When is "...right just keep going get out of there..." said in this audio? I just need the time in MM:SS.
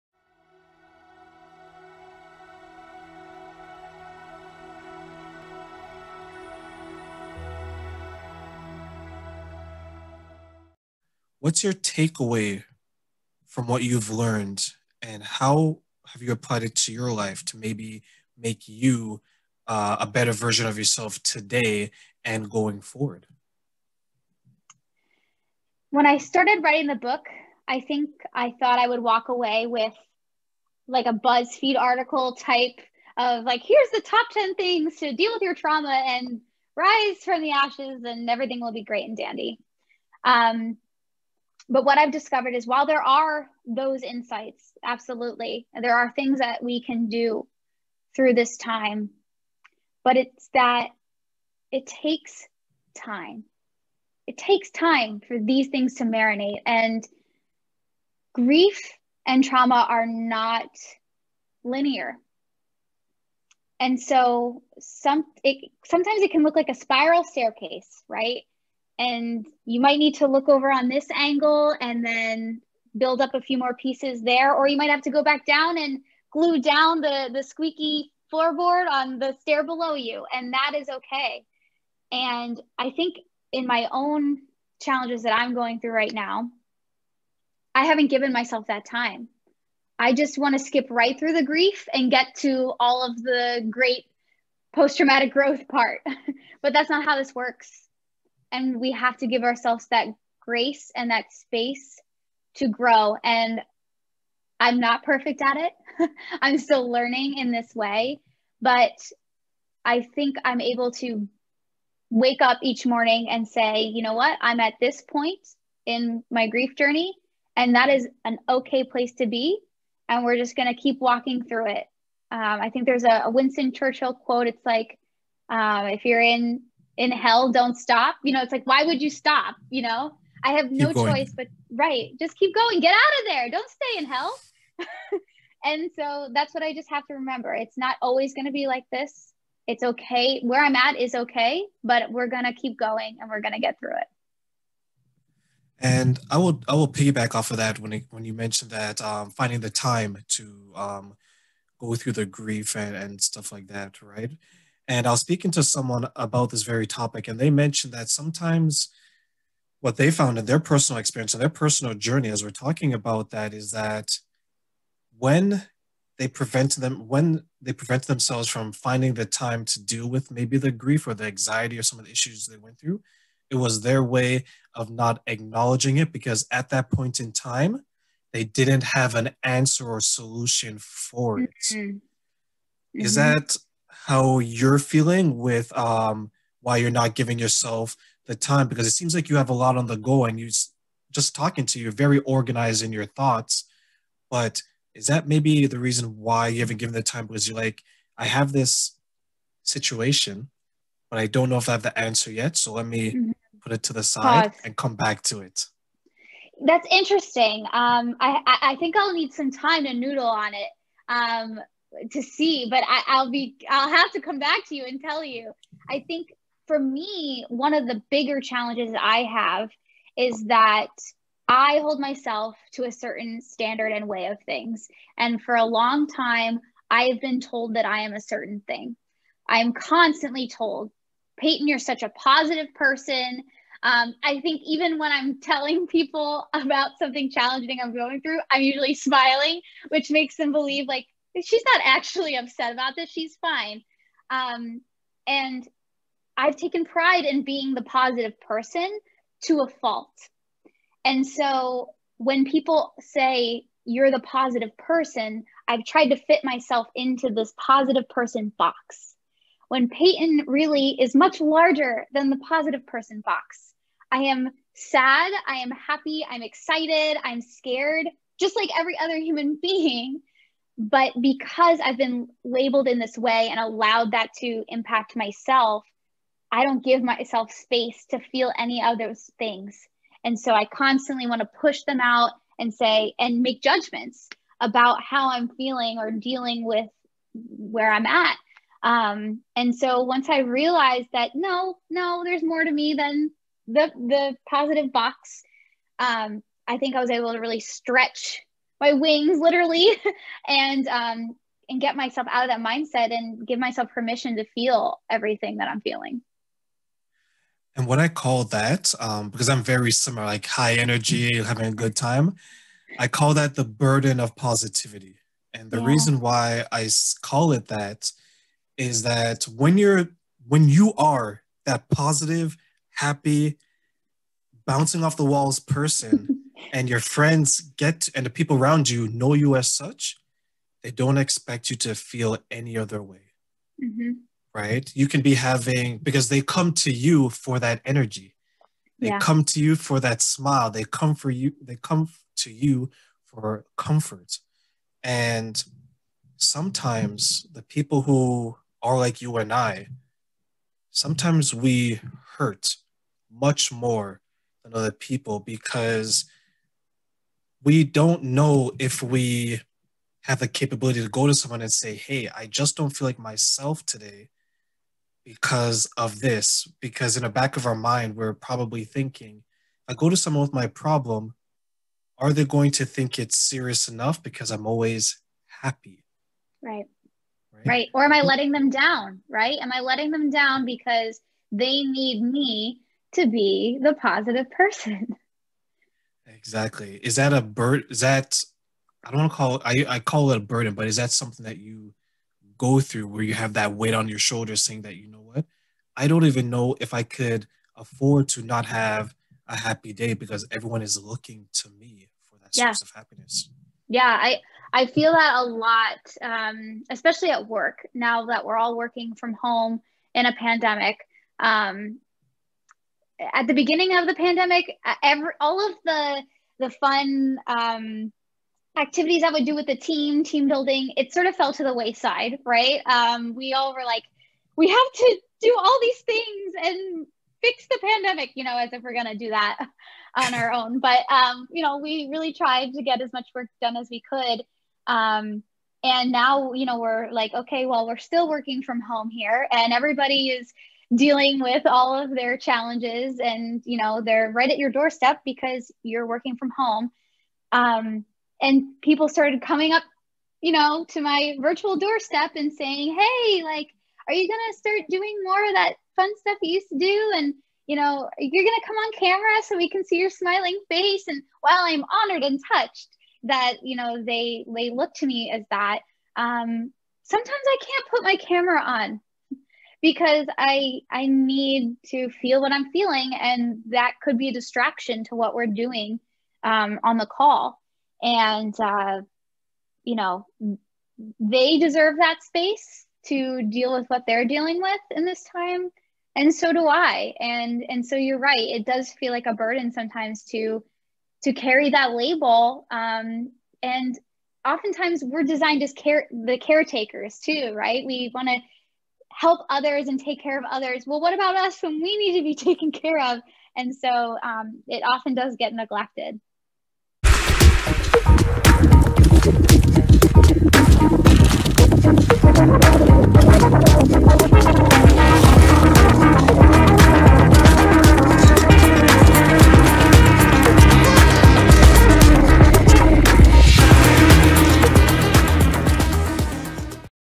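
02:11.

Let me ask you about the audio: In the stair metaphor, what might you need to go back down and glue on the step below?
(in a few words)
Squeaky floorboard.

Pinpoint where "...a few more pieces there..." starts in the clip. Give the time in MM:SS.
01:13.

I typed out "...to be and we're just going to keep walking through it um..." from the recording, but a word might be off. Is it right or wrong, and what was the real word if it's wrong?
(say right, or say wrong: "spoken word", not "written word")
right.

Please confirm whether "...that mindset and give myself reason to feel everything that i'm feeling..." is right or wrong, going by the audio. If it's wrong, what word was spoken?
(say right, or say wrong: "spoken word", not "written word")
wrong: "permission", not "reason".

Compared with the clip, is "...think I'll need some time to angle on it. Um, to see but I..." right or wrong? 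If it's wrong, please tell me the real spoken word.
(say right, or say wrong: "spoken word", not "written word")
wrong: "noodle", not "angle".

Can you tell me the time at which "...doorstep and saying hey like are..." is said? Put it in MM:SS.
07:31.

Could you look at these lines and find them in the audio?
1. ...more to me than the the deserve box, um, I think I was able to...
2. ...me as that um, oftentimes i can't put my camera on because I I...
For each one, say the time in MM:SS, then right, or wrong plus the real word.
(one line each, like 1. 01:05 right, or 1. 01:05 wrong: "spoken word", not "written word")
1. 04:52 wrong: "positive", not "deserve"
2. 07:45 wrong: "sometimes", not "oftentimes".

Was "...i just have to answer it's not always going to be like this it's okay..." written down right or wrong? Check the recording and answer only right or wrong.
wrong.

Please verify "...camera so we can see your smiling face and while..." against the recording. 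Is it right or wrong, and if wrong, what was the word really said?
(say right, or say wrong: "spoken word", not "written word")
right.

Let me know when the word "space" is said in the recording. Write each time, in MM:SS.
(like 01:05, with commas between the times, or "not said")
01:41, 04:37, 08:02.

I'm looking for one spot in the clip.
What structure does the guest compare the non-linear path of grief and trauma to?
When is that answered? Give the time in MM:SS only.
01:06.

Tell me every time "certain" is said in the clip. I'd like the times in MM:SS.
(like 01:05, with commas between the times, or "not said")
03:42, 03:48.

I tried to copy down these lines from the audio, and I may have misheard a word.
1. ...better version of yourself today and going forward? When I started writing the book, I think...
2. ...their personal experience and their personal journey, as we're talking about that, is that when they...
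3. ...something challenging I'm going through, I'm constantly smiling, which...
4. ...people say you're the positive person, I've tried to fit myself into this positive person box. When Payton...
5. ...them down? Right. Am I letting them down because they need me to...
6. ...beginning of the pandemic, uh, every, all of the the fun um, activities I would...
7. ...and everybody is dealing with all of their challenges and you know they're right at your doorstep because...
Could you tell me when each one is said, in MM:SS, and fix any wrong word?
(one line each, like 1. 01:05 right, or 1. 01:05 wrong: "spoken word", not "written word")
1. 00:20 right
2. 02:40 right
3. 03:56 wrong: "usually", not "constantly"
4. 04:12 right
5. 06:18 right
6. 06:53 right
7. 07:19 right.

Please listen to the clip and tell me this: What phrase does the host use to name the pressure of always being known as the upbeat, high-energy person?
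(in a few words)
Burden of positivity.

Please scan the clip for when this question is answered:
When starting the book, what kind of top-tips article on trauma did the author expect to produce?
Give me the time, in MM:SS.
00:31.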